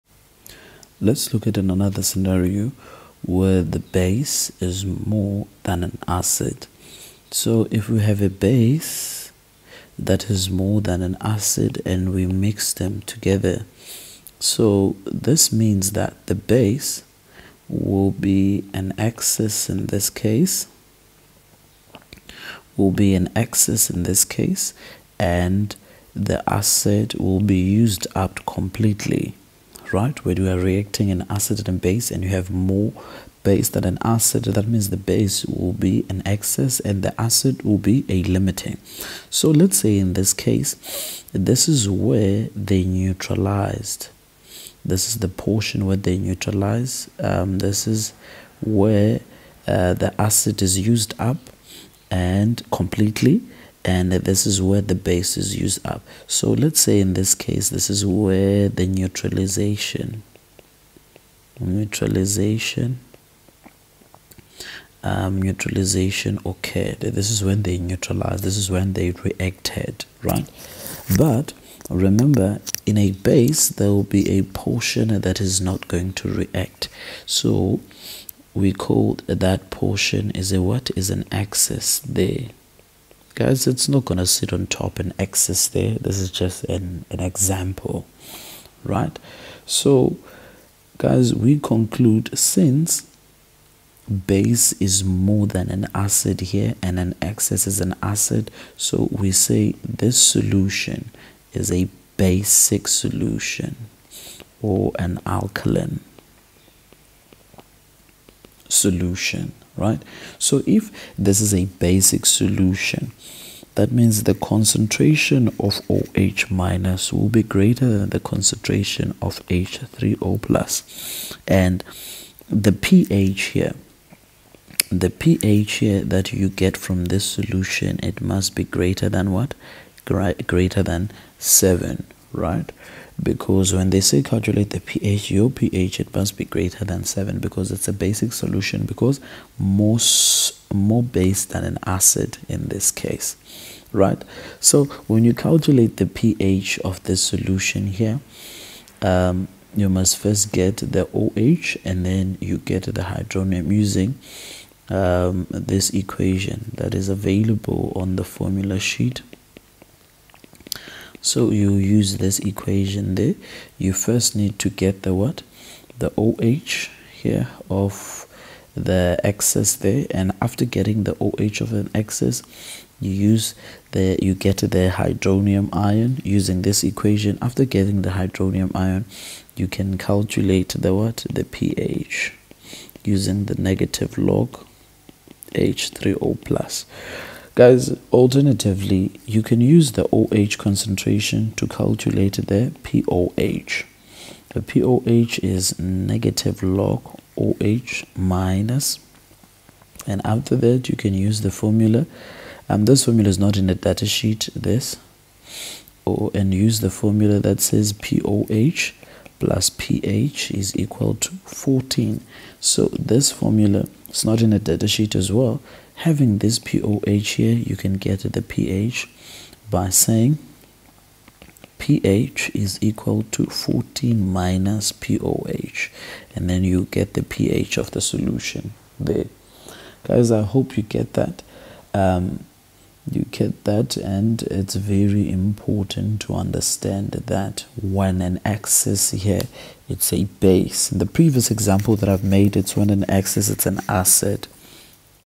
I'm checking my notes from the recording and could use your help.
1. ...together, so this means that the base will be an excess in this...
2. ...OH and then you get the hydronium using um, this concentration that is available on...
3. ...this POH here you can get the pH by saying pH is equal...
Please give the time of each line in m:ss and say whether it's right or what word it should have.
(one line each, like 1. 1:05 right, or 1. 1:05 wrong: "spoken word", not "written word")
1. 0:13 right
2. 2:31 wrong: "equation", not "concentration"
3. 3:36 right.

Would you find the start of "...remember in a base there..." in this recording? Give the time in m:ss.
1:11.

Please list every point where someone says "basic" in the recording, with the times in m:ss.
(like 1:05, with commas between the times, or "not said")
1:42, 1:51, 2:17.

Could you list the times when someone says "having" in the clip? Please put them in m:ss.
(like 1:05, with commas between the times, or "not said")
3:35.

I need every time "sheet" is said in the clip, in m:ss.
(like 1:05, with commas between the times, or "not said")
2:38, 3:24, 3:34.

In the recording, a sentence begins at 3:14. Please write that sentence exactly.
The POH is negative log OH minus, and after that, you can use the formula.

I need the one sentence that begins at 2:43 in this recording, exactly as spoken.
You first need to get the what?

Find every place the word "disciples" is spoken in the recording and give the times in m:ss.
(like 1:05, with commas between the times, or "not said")
not said.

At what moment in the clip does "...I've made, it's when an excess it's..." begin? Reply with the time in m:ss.
4:02.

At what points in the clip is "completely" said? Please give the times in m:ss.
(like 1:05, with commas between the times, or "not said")
0:28, 0:52.